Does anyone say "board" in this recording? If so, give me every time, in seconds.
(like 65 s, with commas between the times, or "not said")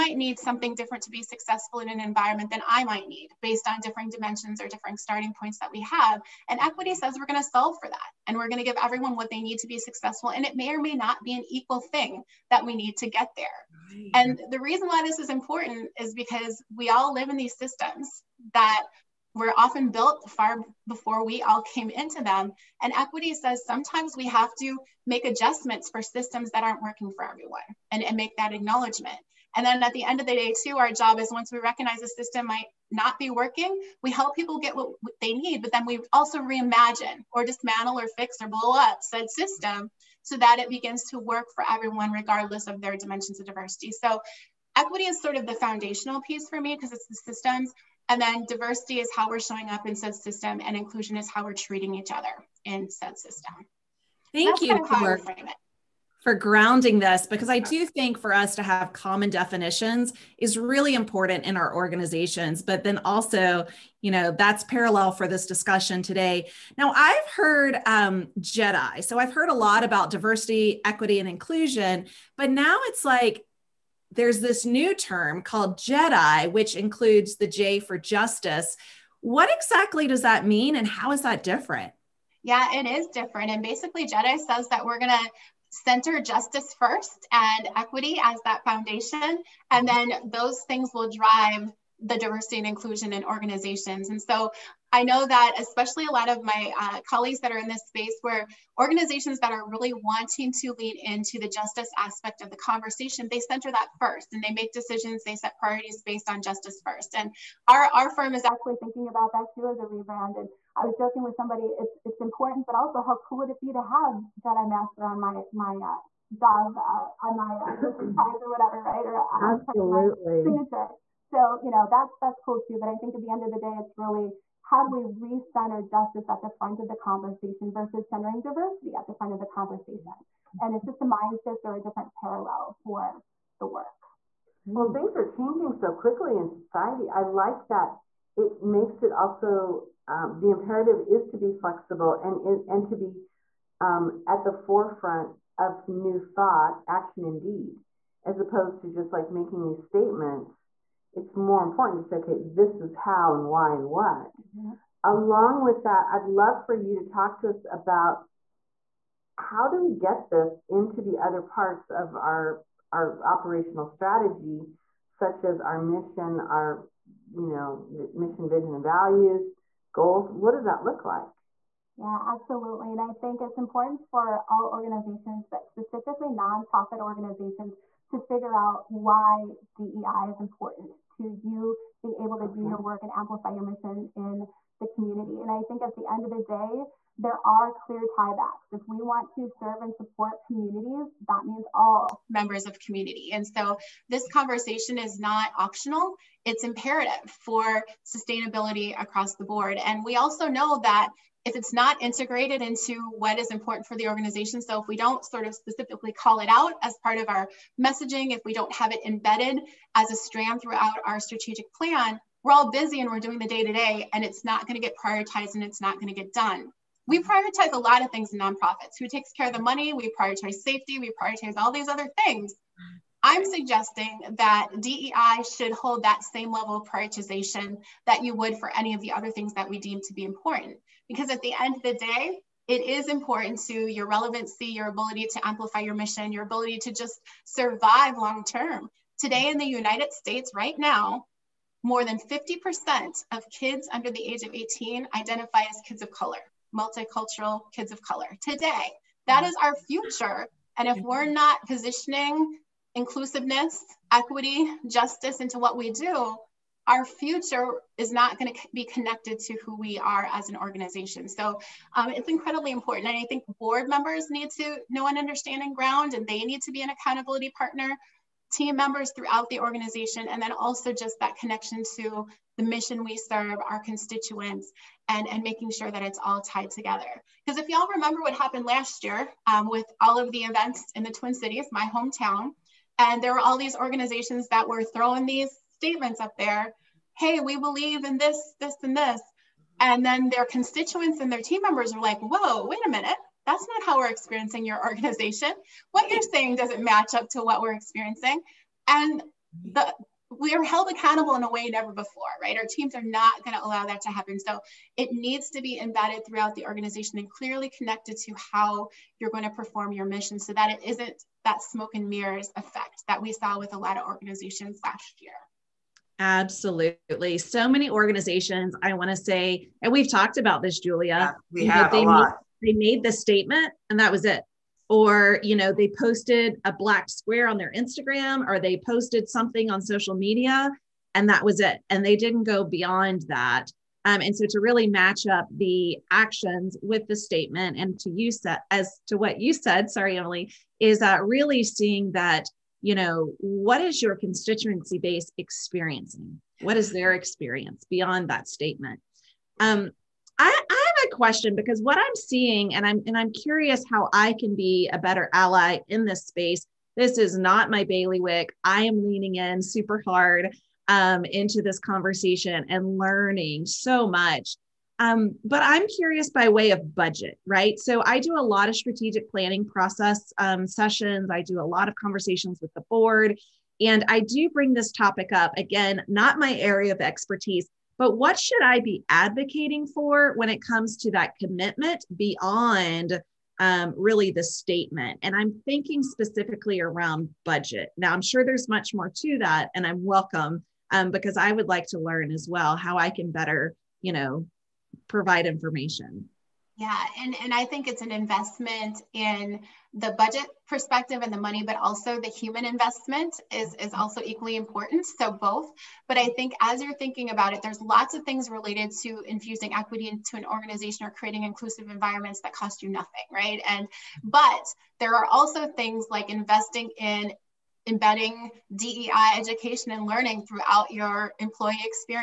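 199 s, 263 s, 372 s.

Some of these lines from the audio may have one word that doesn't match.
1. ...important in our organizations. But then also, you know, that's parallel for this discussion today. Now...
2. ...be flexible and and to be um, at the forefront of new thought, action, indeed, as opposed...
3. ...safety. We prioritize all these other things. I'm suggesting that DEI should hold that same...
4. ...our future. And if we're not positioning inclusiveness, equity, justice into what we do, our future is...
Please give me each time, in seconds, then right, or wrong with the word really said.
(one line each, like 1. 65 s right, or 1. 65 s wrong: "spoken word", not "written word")
1. 60 s right
2. 141 s right
3. 220 s right
4. 249 s right.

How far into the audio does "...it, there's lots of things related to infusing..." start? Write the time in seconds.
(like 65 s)
407 s.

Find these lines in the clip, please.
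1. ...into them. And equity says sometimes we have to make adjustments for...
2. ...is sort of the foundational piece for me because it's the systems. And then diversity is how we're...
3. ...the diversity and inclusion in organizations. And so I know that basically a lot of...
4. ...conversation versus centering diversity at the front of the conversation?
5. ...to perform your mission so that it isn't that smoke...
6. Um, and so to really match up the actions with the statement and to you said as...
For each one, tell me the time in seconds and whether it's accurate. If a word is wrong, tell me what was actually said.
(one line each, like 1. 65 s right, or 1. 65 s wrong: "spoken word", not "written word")
1. 21 s right
2. 45 s right
3. 91 s wrong: "especially", not "basically"
4. 126 s right
5. 309 s right
6. 334 s right.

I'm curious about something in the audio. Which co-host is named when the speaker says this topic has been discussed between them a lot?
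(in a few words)
Julia.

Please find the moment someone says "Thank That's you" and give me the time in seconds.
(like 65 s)
54 s.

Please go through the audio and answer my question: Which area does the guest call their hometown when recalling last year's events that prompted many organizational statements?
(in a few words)
Twin Cities.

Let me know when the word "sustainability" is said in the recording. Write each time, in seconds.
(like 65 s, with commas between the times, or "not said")
198 s.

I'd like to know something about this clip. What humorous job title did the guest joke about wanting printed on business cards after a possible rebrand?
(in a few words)
Jedi Master.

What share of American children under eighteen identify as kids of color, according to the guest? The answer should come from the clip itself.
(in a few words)
more than 50%.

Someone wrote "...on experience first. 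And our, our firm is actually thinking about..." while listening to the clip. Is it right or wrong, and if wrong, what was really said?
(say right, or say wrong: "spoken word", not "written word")
wrong: "justice", not "experience".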